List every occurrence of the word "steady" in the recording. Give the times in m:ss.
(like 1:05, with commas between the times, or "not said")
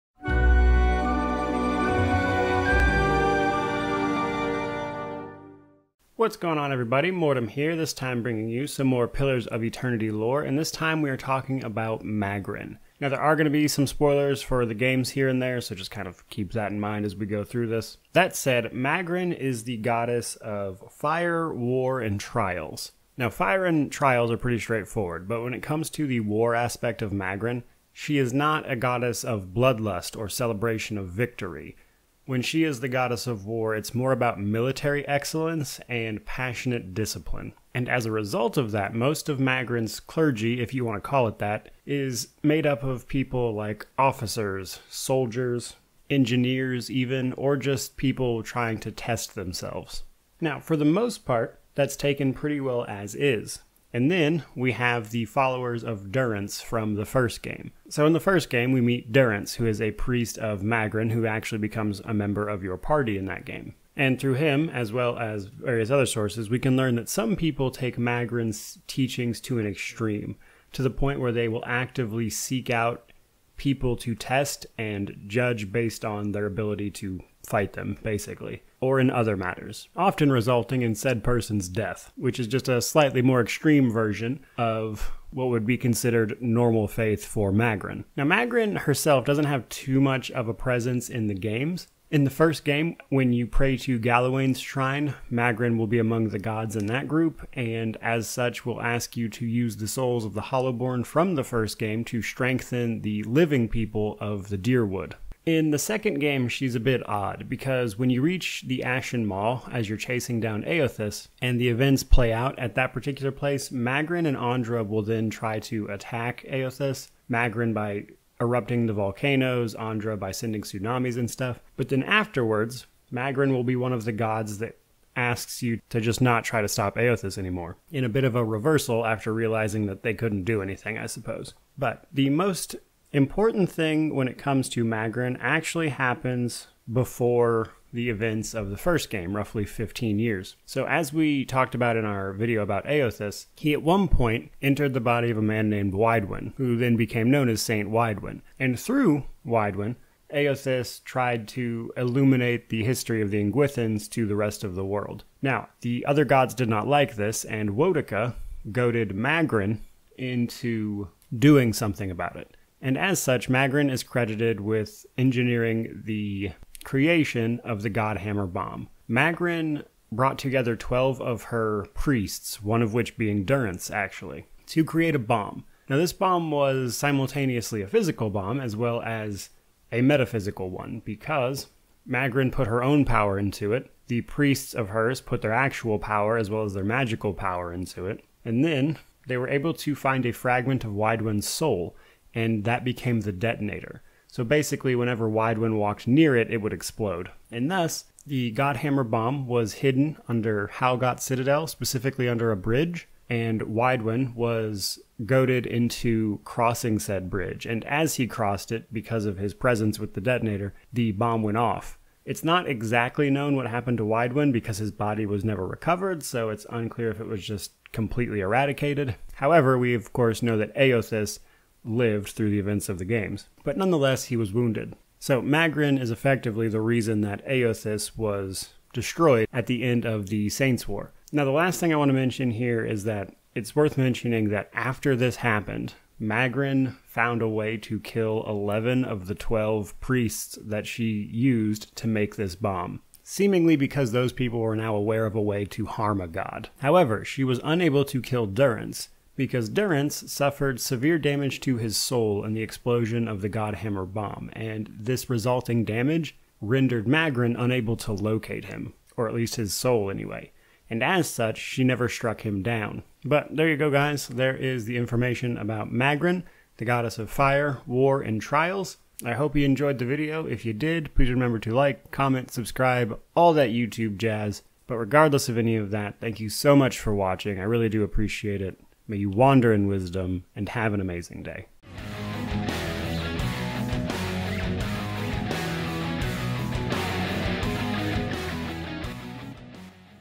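not said.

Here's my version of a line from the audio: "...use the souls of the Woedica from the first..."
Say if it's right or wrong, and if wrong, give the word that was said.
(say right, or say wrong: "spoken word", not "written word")
wrong: "Hollowborn", not "Woedica".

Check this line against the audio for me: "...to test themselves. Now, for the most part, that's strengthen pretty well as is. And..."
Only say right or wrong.
wrong.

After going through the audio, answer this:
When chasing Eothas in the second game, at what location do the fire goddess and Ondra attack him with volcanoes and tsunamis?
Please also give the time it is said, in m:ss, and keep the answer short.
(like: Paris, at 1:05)
Ashen Maw, at 1:48.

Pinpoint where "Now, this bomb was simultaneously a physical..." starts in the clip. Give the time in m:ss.
2:55.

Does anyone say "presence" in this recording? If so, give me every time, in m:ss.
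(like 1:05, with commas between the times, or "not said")
1:30, 3:29.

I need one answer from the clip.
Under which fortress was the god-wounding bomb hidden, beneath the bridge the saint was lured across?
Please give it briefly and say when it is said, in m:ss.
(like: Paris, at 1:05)
Halgot Citadel, at 3:20.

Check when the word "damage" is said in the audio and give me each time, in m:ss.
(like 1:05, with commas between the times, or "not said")
4:11, 4:15.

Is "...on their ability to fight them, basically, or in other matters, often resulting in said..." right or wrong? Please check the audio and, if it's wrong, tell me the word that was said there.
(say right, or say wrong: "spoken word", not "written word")
right.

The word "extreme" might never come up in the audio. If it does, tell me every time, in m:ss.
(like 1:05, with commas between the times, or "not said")
1:09, 1:23.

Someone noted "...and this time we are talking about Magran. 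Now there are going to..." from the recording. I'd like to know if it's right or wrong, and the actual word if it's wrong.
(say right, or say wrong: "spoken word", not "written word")
right.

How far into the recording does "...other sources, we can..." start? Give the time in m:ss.
1:05.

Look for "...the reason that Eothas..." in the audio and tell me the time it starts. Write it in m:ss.
3:46.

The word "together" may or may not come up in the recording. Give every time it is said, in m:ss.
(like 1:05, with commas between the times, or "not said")
2:50.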